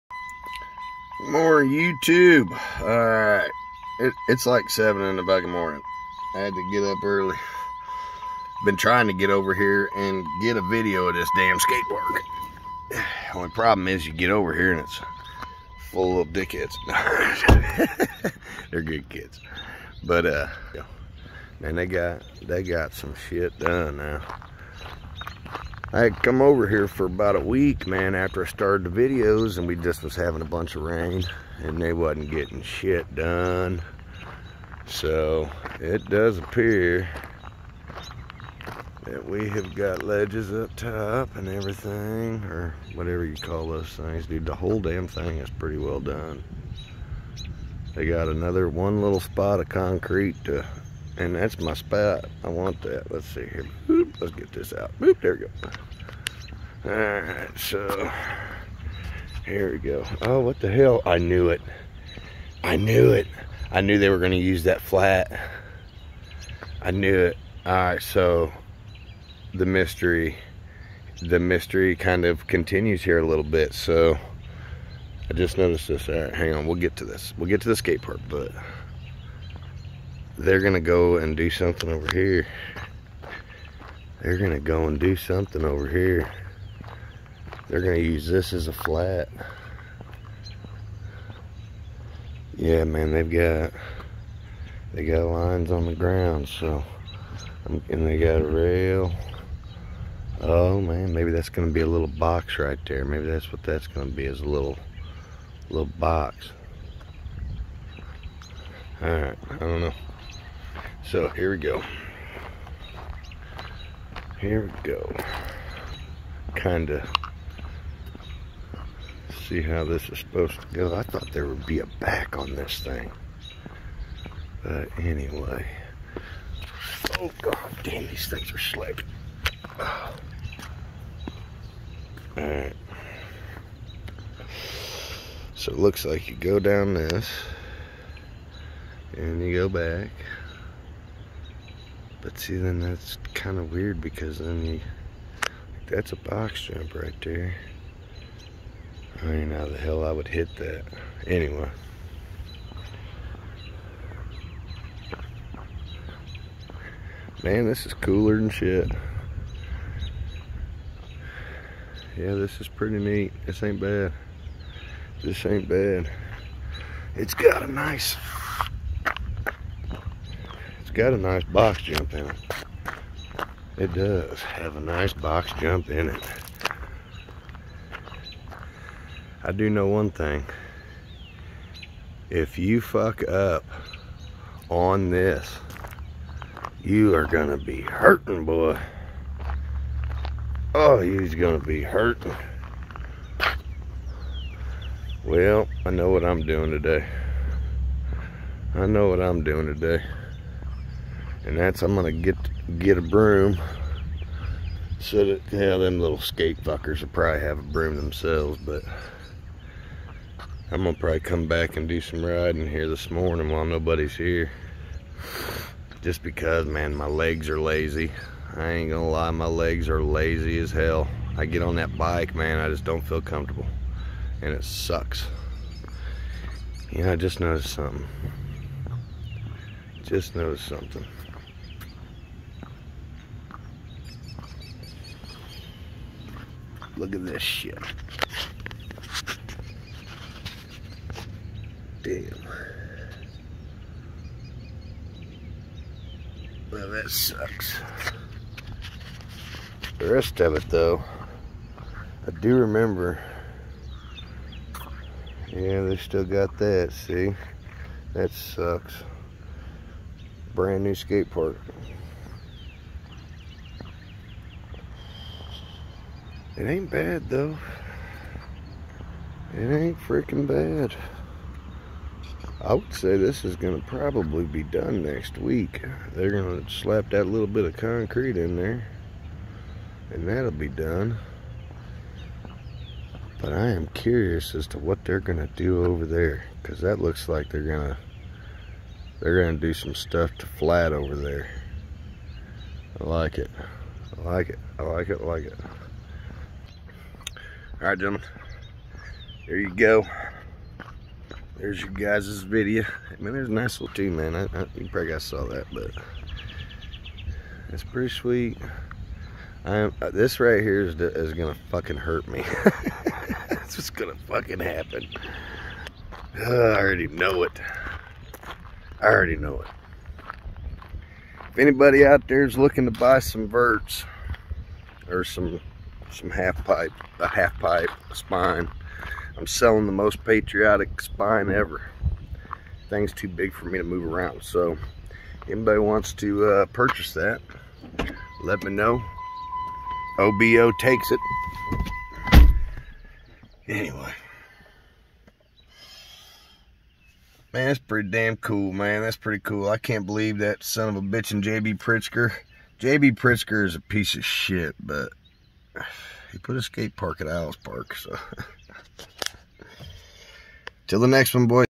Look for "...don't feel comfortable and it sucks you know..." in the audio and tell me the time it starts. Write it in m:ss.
3:42.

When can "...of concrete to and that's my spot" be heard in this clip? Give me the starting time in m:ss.
0:49.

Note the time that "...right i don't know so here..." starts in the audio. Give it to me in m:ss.
1:49.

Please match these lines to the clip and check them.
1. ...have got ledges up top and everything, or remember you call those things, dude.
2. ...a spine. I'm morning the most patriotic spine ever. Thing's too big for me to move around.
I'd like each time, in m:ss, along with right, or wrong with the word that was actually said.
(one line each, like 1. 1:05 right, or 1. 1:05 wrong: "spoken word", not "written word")
1. 0:39 wrong: "whatever", not "remember"
2. 5:28 wrong: "selling", not "morning".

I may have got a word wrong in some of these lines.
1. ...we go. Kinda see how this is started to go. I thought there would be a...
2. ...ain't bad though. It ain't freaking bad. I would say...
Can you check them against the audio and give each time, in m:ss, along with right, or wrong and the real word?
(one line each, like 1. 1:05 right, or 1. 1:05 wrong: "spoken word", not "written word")
1. 1:54 wrong: "supposed", not "started"
2. 4:26 right.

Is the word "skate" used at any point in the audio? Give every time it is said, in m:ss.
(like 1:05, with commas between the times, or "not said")
0:11, 1:17, 3:26, 4:20, 5:56.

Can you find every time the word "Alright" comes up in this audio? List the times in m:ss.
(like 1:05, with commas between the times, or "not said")
0:02, 0:56, 1:07, 1:16, 2:12.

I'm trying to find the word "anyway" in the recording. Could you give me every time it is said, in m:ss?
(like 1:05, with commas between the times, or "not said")
2:04, 2:31, 5:43.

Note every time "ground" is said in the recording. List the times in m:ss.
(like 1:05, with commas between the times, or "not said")
1:35.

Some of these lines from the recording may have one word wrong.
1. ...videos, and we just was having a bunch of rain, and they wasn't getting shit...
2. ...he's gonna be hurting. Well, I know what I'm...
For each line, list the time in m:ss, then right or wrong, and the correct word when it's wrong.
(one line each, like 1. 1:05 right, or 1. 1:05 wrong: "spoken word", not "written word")
1. 0:29 right
2. 3:10 right.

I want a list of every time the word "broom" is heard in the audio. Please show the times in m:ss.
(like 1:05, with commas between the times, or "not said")
3:23, 3:27.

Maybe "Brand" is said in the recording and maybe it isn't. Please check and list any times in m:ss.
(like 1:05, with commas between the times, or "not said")
4:20.